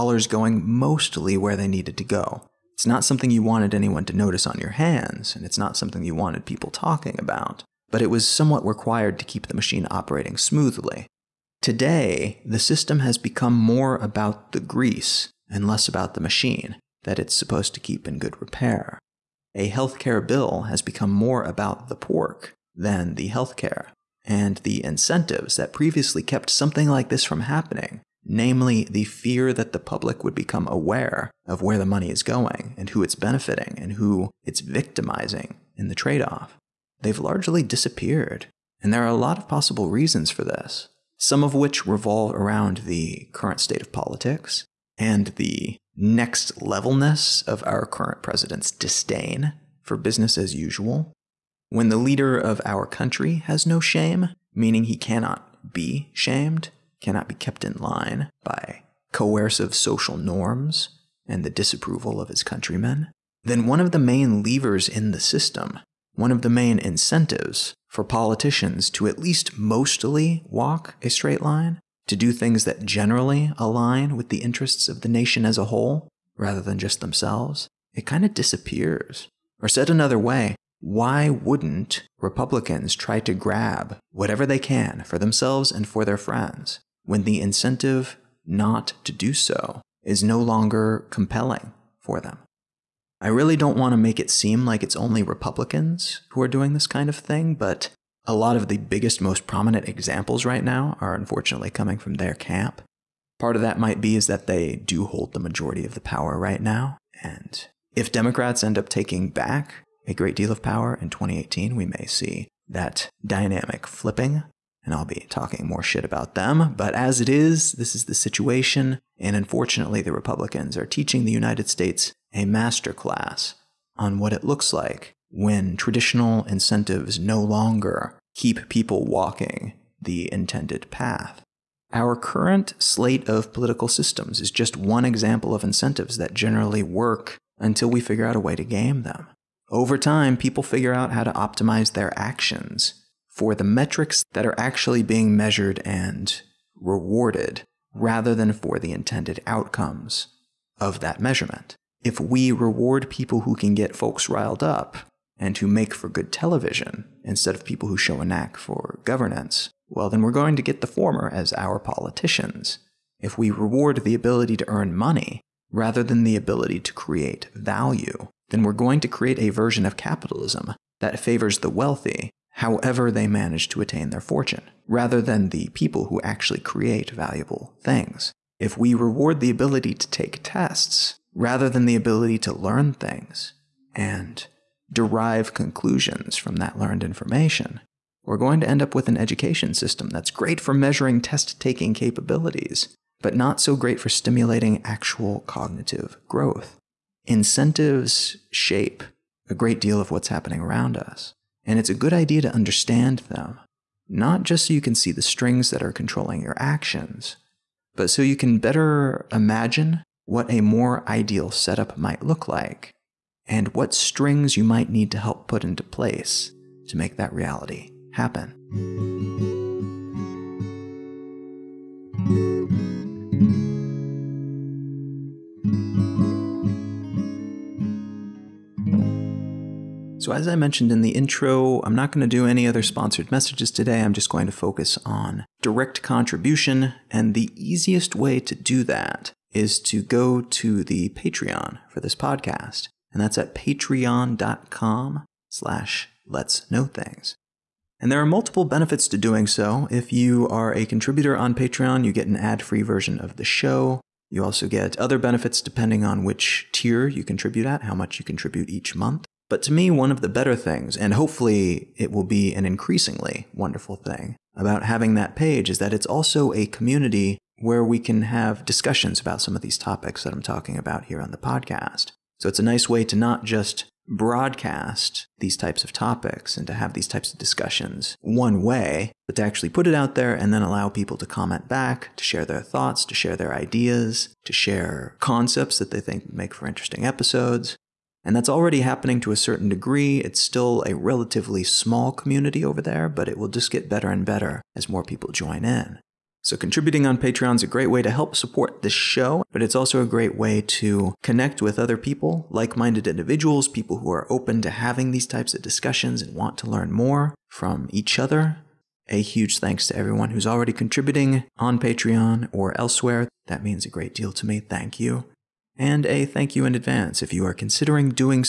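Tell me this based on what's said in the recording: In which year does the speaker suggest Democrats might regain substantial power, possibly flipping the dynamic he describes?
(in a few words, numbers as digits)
2018.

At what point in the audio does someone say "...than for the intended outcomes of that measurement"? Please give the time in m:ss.
2:28.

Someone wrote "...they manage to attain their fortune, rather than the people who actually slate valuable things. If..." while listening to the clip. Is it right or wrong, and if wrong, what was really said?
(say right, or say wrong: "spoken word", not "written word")
wrong: "create", not "slate".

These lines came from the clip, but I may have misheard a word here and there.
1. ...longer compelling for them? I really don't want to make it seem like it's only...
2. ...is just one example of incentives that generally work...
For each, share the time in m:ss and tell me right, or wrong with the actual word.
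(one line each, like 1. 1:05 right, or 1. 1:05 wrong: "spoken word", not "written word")
1. 1:30 right
2. 2:14 right.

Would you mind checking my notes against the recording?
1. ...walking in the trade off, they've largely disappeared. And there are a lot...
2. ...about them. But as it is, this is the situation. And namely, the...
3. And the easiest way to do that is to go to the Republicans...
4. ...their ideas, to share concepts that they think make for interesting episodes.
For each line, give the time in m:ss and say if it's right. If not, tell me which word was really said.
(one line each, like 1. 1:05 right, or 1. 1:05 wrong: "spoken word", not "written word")
1. 0:34 wrong: "victimizing", not "walking"
2. 1:56 wrong: "unfortunately", not "namely"
3. 3:57 wrong: "Patreon", not "Republicans"
4. 4:43 right.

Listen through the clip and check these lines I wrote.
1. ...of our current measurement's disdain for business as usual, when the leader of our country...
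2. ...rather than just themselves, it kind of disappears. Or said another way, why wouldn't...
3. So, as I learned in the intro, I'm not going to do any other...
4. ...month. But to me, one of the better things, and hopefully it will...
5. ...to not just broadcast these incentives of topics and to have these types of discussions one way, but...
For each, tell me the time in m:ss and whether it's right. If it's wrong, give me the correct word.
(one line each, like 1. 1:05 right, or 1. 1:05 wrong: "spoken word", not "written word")
1. 0:47 wrong: "president", not "measurement"
2. 1:16 right
3. 3:50 wrong: "mentioned", not "learned"
4. 4:18 right
5. 4:33 wrong: "types", not "incentives".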